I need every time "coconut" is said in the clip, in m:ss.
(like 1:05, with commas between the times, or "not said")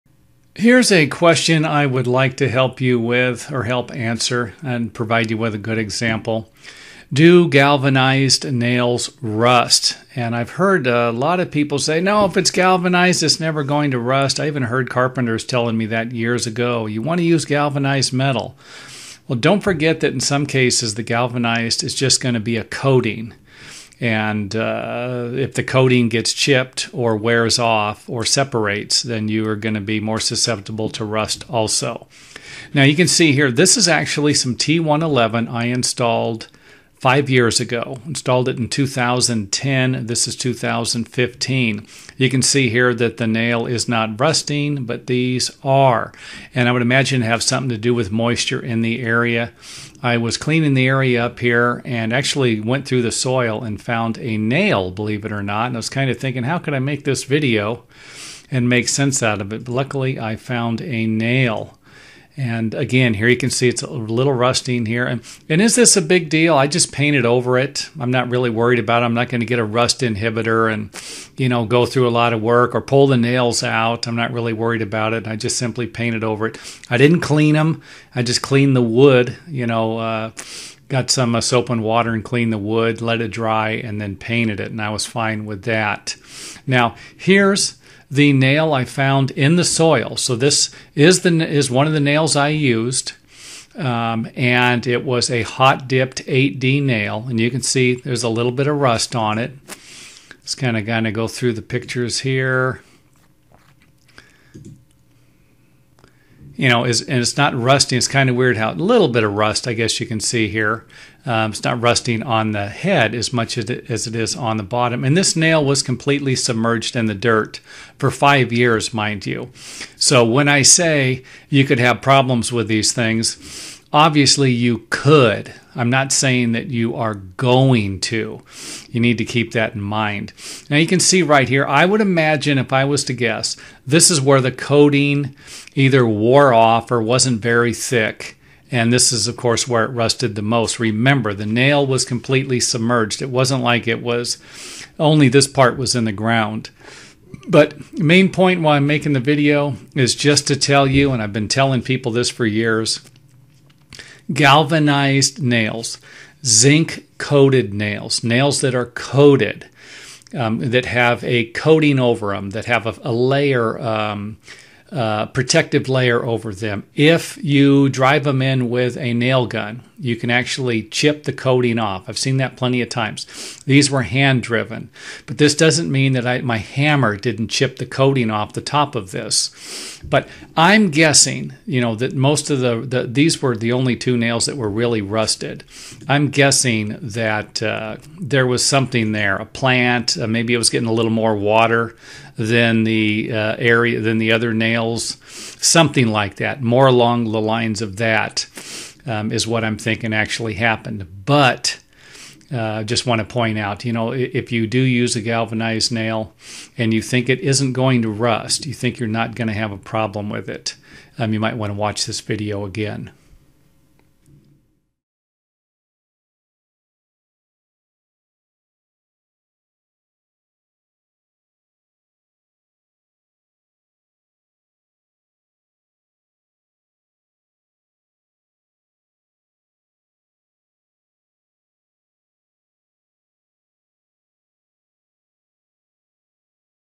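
not said.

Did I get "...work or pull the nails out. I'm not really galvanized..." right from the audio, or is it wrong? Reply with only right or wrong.
wrong.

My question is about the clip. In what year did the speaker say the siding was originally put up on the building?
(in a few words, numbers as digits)
2010.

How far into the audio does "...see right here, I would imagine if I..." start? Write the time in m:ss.
2:11.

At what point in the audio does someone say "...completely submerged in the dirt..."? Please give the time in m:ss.
1:55.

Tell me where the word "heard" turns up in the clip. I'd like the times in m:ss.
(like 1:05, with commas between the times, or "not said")
0:10, 0:14.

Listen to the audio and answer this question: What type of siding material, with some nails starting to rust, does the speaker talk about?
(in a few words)
T111.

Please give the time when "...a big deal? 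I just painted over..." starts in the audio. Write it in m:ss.
1:05.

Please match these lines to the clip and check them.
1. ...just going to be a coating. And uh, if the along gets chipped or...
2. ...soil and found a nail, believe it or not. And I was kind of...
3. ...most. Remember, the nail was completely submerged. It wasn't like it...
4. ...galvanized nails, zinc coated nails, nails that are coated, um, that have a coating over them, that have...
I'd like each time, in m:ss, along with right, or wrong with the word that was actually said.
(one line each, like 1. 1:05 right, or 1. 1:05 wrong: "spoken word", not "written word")
1. 0:21 wrong: "coating", not "along"
2. 0:53 right
3. 2:20 right
4. 2:34 right.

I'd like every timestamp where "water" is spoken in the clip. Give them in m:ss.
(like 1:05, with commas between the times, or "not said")
1:21, 3:11.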